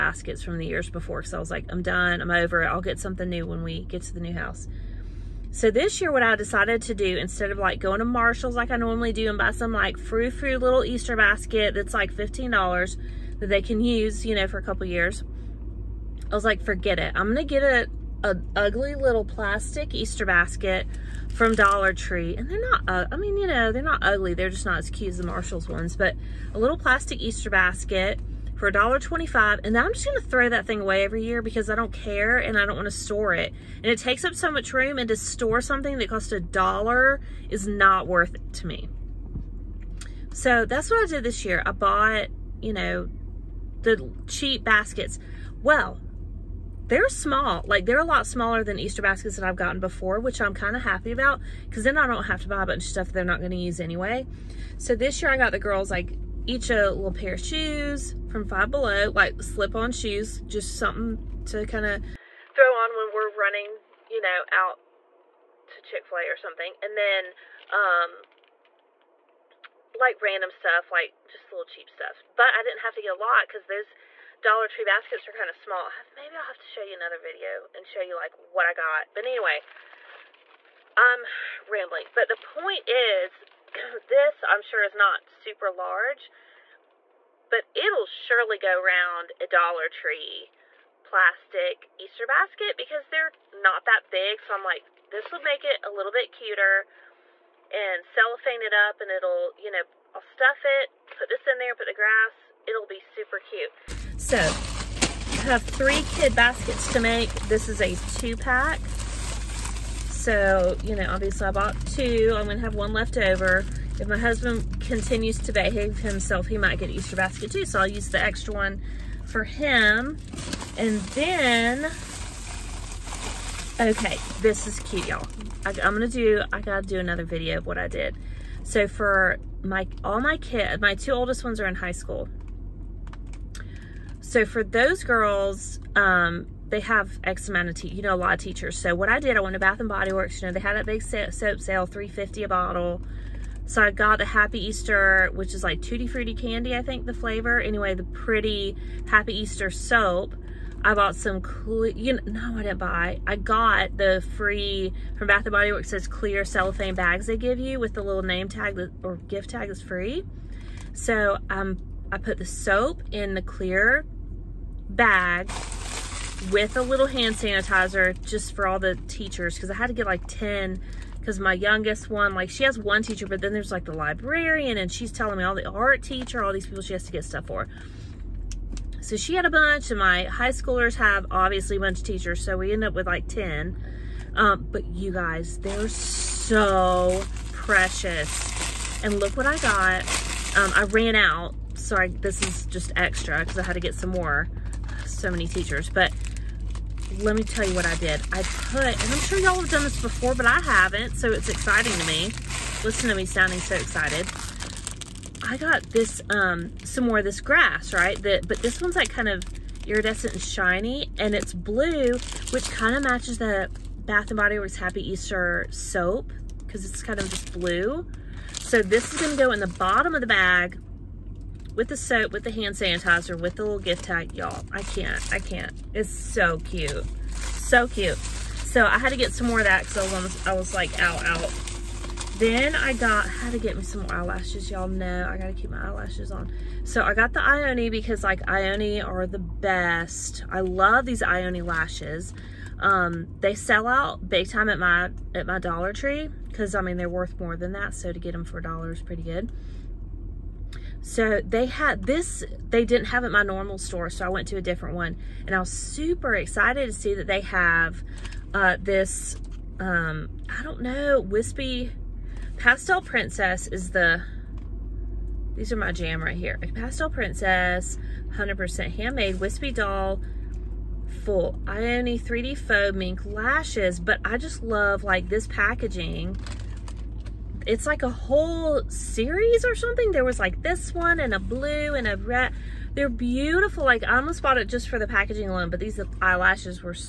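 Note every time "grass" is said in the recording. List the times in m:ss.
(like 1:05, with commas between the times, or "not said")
1:41, 3:27.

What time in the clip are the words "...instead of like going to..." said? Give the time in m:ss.
0:07.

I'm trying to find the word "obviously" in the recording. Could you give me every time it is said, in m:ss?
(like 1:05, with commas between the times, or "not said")
1:51, 3:01.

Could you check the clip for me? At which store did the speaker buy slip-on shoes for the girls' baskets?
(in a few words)
Five Below.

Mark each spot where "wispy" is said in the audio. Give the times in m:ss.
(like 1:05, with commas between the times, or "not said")
4:21, 4:29.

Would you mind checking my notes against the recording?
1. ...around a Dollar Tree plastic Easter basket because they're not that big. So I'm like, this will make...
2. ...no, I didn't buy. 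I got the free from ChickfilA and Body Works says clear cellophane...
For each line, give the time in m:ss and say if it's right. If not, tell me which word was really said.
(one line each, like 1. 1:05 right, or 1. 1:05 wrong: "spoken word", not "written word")
1. 1:28 right
2. 2:32 wrong: "Bath", not "ChickfilA".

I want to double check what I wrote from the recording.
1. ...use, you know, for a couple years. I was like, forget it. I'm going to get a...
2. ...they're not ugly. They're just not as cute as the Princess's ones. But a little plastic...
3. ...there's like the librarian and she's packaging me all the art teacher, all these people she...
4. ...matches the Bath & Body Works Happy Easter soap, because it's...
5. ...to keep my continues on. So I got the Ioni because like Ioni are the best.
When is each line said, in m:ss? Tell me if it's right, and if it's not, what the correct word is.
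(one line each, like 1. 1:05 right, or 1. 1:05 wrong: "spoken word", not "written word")
1. 0:13 right
2. 0:23 wrong: "Marshall", not "Princess"
3. 2:53 wrong: "telling", not "packaging"
4. 3:33 right
5. 3:55 wrong: "eyelashes", not "continues".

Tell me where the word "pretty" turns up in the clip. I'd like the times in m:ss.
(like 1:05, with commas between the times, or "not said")
2:28, 4:09.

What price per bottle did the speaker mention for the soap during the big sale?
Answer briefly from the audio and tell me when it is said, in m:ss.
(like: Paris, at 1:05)
$3.50, at 2:21.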